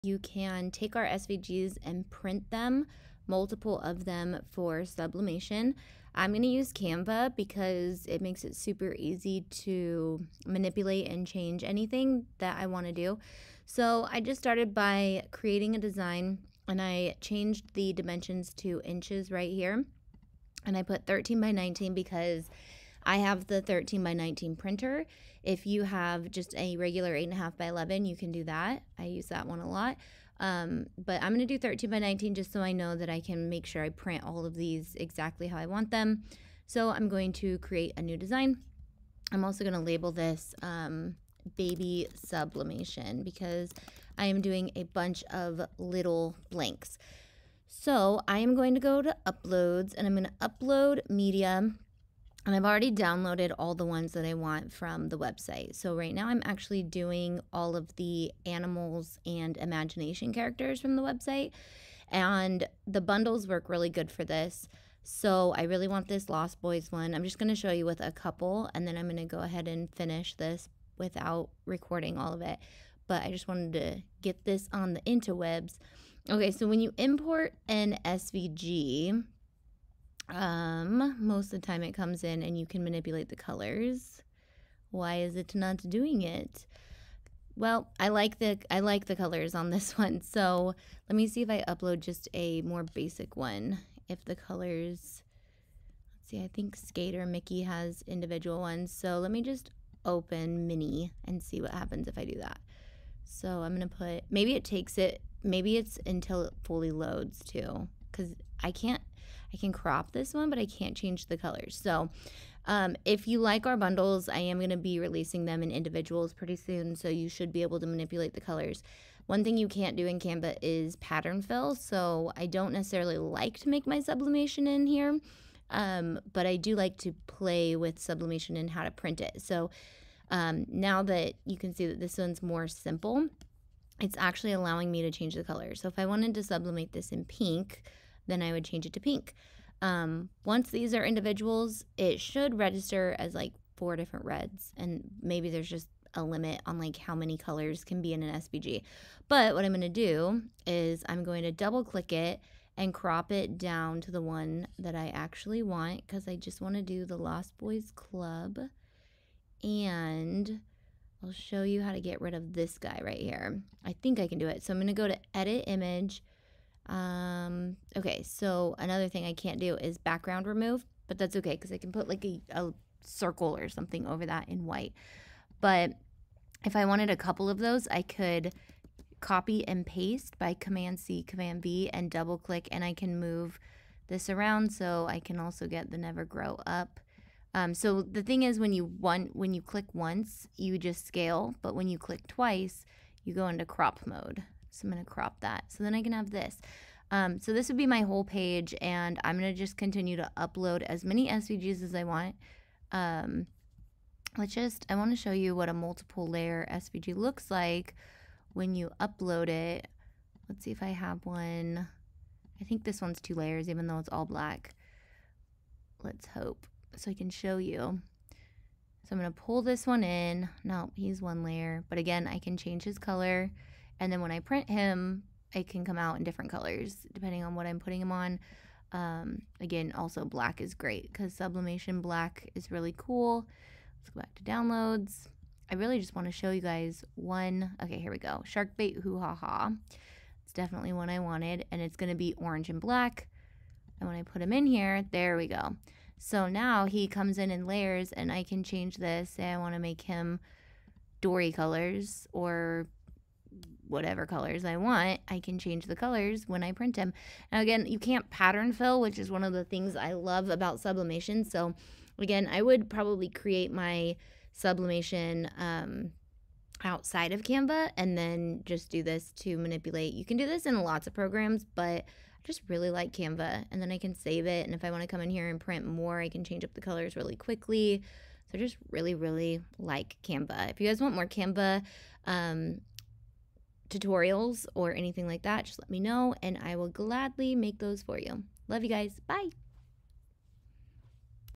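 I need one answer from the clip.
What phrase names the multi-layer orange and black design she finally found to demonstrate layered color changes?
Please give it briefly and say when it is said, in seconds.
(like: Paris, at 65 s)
Shark bait hoo ha ha, at 238 s.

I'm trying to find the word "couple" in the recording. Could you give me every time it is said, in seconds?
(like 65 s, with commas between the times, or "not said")
68 s, 177 s.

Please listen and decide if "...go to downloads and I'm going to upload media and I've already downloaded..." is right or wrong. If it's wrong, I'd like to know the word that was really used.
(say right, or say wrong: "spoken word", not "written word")
wrong: "uploads", not "downloads".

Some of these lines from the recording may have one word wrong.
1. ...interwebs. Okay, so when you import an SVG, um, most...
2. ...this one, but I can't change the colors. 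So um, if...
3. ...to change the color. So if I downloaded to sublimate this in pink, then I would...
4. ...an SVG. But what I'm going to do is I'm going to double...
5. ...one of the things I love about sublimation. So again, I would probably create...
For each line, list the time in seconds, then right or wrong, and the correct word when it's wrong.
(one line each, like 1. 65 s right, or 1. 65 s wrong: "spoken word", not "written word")
1. 75 s right
2. 110 s right
3. 135 s wrong: "wanted", not "downloaded"
4. 148 s right
5. 259 s right.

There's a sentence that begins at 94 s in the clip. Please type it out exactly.
If the colors, let's see, I think Skater Mickey has individual ones.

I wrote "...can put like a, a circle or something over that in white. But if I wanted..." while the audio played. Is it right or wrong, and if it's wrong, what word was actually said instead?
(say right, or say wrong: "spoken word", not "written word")
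right.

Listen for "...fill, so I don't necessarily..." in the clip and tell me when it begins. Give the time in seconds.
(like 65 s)
121 s.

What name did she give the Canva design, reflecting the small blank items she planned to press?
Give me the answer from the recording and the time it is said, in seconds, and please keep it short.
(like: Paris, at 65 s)
baby sublimation, at 41 s.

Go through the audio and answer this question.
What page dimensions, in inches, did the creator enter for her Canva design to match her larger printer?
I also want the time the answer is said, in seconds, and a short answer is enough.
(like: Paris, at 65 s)
13 by 19, at 21 s.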